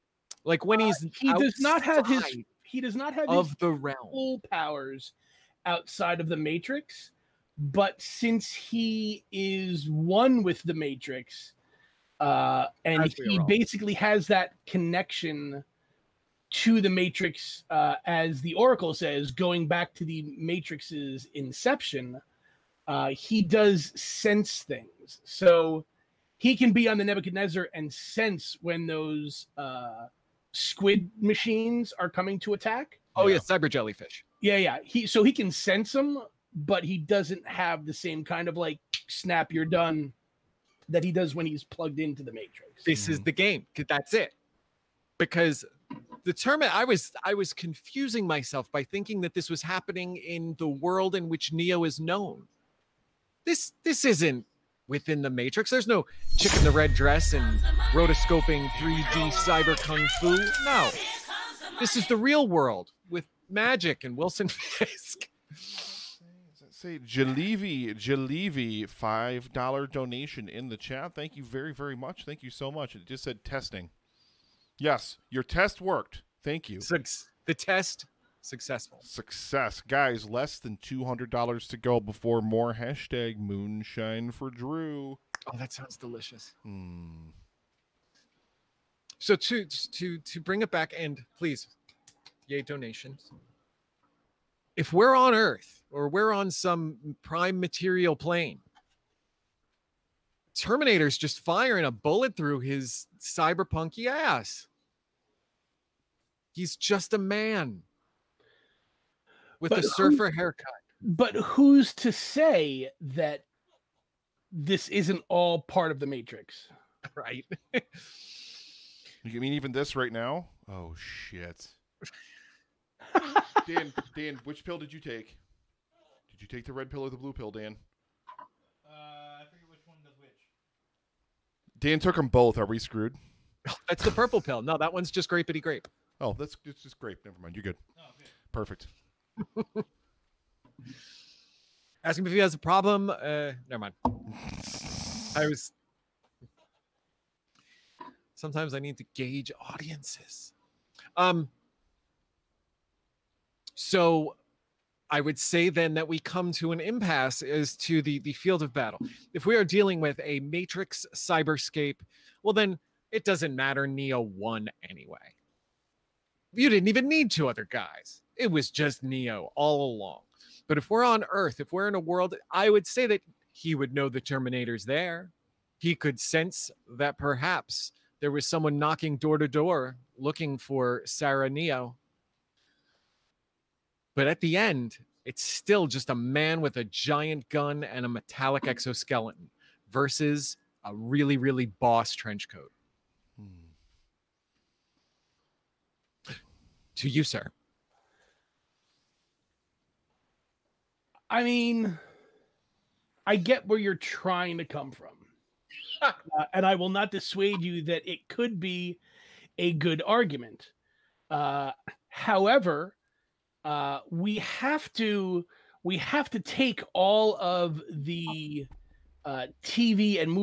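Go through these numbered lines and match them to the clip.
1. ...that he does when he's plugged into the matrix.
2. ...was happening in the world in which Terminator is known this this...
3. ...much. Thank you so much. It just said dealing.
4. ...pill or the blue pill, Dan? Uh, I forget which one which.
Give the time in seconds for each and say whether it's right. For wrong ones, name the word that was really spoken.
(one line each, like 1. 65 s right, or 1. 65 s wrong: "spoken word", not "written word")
1. 40 s right
2. 49 s wrong: "Neo", not "Terminator"
3. 71 s wrong: "testing", not "dealing"
4. 126 s right.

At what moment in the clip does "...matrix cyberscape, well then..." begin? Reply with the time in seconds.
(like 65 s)
160 s.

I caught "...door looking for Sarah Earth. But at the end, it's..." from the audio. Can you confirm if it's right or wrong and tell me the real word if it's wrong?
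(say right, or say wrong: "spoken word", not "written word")
wrong: "Neo", not "Earth".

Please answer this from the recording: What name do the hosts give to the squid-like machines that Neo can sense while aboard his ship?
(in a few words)
cyber jellyfish.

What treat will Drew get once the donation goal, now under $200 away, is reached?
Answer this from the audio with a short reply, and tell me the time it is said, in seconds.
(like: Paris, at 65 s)
moonshine, at 83 s.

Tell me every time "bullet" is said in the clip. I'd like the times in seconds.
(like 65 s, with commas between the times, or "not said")
101 s.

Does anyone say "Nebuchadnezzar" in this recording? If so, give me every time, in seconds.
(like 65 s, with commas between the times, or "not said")
27 s.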